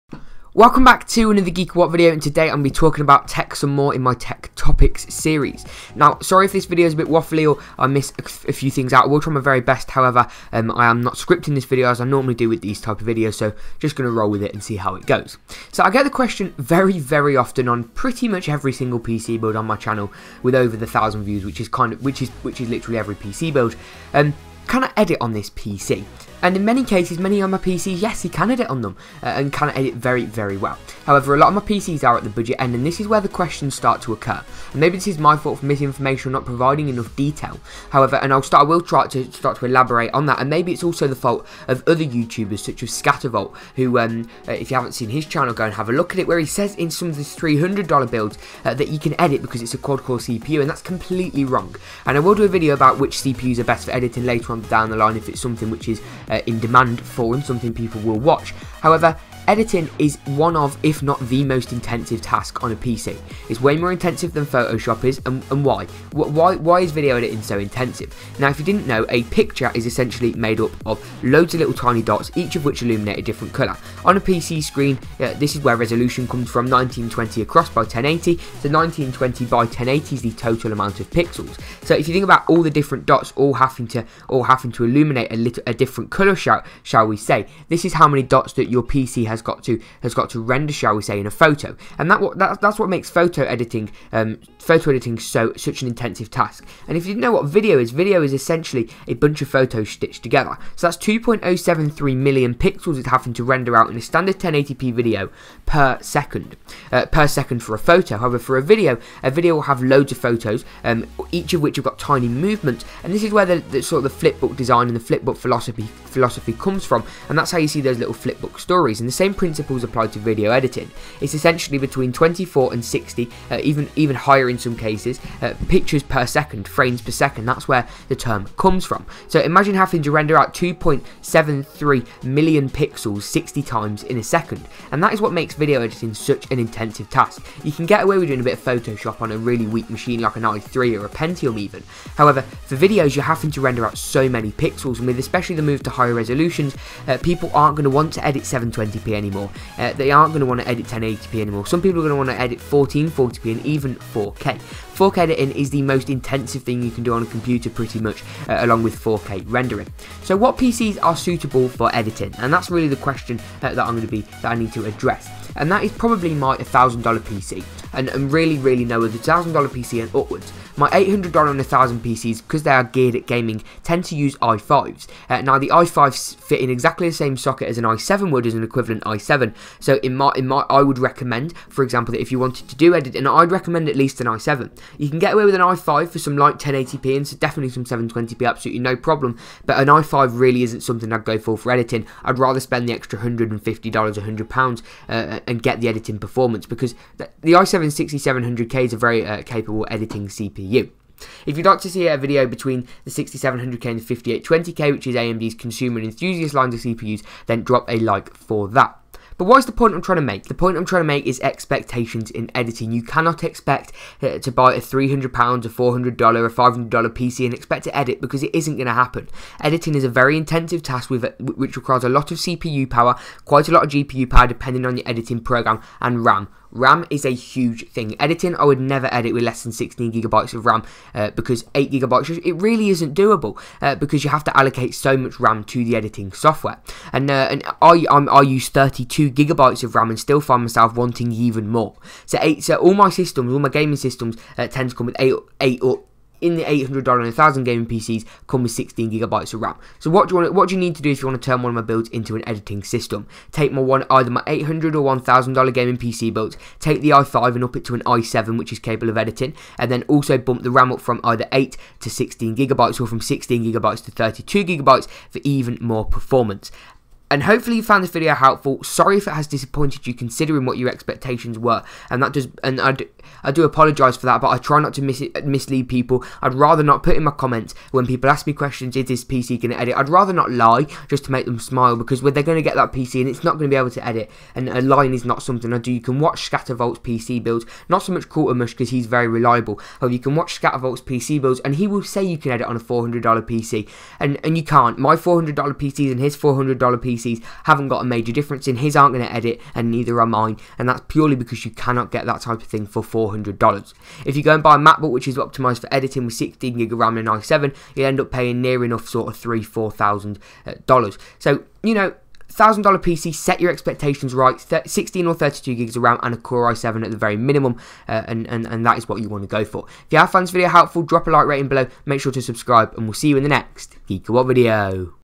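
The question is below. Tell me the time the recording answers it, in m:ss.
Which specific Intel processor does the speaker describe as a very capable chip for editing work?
3:17.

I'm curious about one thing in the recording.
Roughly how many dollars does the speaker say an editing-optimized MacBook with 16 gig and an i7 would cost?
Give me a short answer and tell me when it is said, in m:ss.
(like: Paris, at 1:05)
3,000 to 4,000, at 5:09.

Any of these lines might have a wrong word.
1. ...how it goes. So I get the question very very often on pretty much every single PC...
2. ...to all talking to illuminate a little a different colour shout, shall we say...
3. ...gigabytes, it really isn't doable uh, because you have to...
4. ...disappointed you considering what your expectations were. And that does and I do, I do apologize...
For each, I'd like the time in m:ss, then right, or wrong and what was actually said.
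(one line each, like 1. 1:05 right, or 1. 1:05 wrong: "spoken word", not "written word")
1. 0:14 right
2. 1:23 wrong: "having", not "talking"
3. 3:51 right
4. 4:29 right.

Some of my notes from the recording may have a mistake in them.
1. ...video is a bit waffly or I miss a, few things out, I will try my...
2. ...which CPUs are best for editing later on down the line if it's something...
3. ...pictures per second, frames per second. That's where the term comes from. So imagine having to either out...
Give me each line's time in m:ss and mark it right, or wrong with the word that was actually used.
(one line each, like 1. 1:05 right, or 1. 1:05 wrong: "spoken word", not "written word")
1. 0:06 right
2. 0:52 right
3. 2:05 wrong: "render", not "either".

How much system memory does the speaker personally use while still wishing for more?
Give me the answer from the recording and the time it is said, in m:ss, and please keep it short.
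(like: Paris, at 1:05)
32 gigabytes, at 3:58.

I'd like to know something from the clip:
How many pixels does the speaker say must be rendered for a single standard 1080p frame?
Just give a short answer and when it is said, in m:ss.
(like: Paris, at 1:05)
2.073 million, at 1:40.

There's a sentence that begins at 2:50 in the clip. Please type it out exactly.
My $800 and 1000 PCs, because they are geared at gaming, tend to use i5s.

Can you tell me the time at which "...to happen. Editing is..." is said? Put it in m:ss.
3:38.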